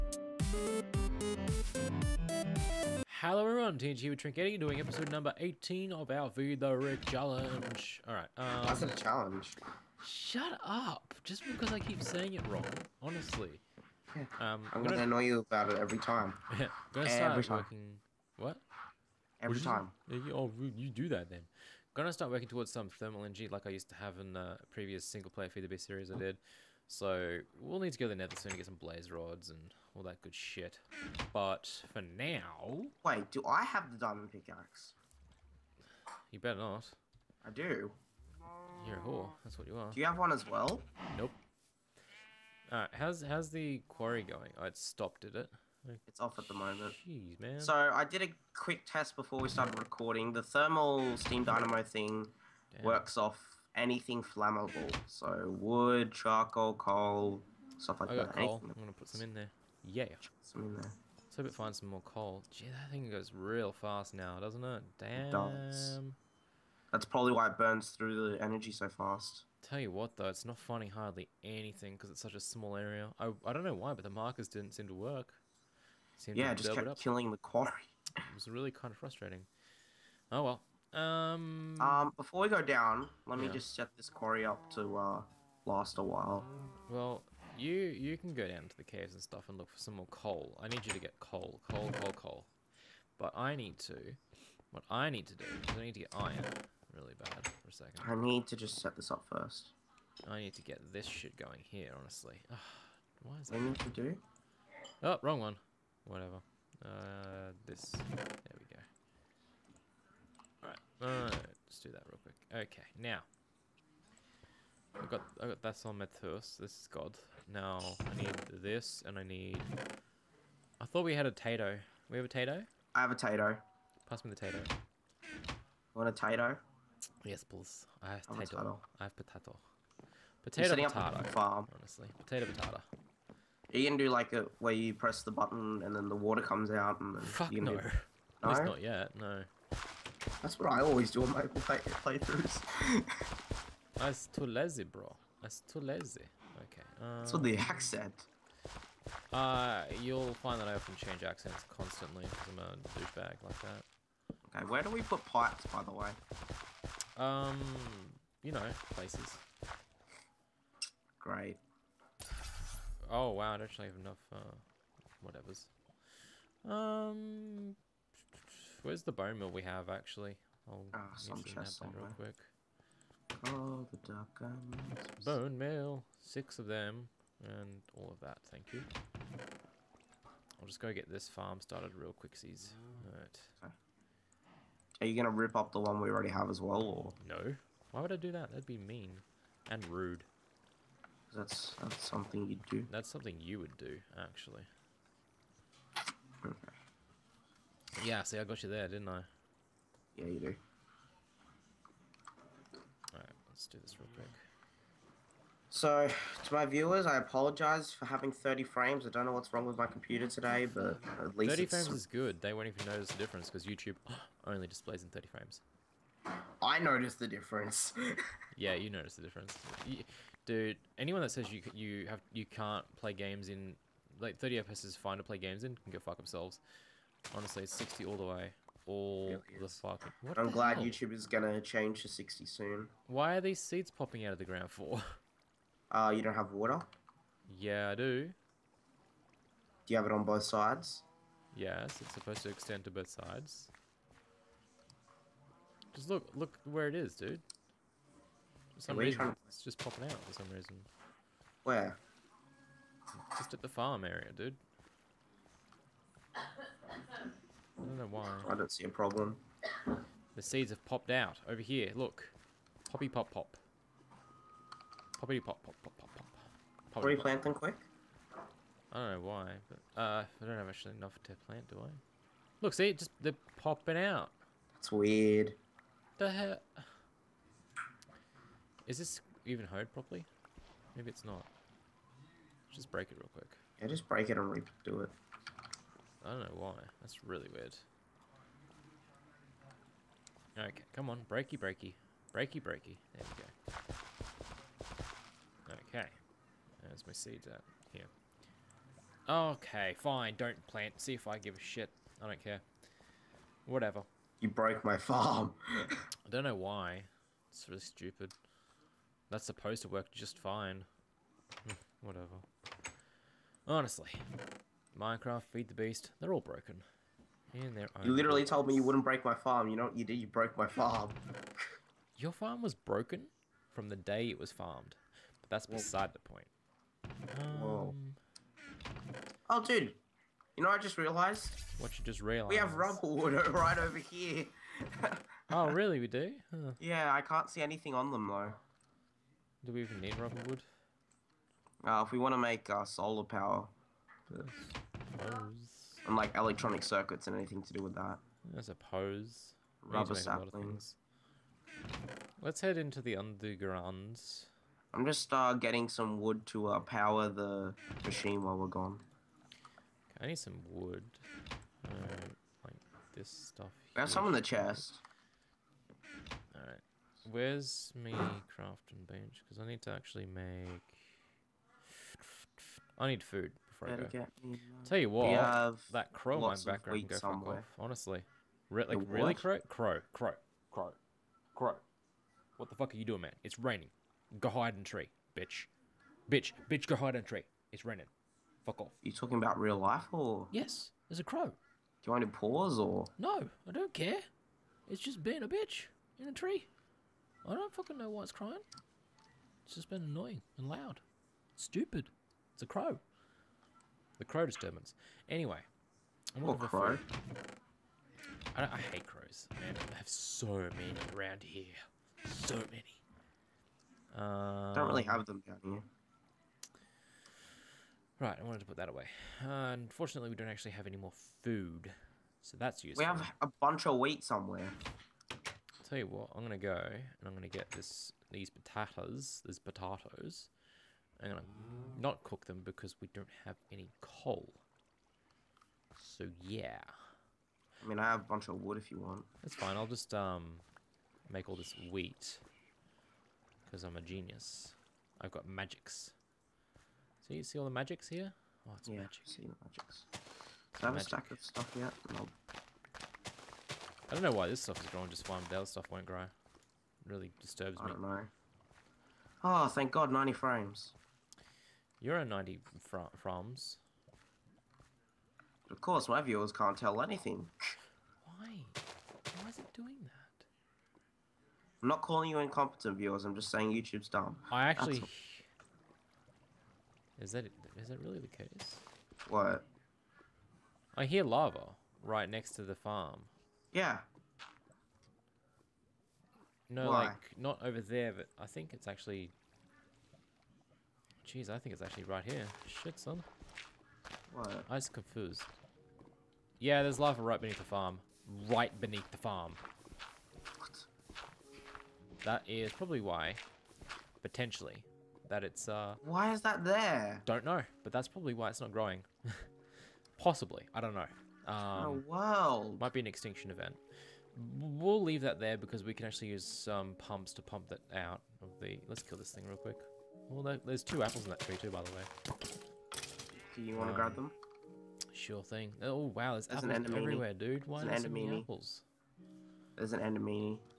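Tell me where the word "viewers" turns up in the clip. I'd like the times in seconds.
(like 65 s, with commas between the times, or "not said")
206 s, 466 s, 472 s.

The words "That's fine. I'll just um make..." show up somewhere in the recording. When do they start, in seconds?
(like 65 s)
439 s.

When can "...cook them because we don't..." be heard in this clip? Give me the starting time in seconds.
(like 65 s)
432 s.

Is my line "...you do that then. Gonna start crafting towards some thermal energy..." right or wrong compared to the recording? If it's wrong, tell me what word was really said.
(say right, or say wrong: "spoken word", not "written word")
wrong: "working", not "crafting".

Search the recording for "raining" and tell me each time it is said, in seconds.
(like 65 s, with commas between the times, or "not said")
383 s, 387 s.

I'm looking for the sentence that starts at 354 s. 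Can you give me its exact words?
I'm just uh, getting some wood to uh, power the machine while we're gone.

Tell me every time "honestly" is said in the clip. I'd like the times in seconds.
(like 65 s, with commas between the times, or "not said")
12 s, 101 s, 131 s, 227 s, 313 s, 377 s.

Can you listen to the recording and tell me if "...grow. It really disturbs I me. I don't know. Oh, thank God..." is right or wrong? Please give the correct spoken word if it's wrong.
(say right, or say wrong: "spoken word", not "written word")
right.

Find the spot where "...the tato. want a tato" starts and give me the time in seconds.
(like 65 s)
124 s.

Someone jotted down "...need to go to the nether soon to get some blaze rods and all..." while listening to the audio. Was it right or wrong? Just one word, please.
right.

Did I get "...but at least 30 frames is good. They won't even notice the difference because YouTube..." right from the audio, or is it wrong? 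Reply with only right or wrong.
right.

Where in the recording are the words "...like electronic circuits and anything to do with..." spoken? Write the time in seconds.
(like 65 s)
346 s.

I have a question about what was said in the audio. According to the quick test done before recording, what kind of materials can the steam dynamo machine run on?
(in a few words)
anything flammable.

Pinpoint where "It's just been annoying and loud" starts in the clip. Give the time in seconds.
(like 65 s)
399 s.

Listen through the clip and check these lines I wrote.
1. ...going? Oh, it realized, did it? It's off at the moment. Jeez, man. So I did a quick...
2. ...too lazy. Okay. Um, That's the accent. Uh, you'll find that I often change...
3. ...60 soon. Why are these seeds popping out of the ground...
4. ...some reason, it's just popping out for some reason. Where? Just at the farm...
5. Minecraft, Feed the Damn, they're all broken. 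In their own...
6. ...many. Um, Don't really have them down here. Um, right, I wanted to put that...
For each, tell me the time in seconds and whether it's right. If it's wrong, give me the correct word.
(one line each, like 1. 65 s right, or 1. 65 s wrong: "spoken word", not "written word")
1. 44 s wrong: "stopped", not "realized"
2. 145 s right
3. 232 s right
4. 248 s right
5. 314 s wrong: "Beast", not "Damn"
6. 412 s right.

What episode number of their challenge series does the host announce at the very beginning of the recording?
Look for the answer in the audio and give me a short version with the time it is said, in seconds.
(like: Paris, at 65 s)
18, at 4 s.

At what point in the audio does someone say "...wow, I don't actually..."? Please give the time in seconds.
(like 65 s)
163 s.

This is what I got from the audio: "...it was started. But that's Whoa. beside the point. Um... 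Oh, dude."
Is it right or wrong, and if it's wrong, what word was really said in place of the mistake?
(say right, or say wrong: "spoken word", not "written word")
wrong: "farmed", not "started".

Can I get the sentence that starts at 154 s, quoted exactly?
Okay, where do we put pipes, by the way?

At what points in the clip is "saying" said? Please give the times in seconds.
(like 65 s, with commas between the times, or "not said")
12 s, 473 s.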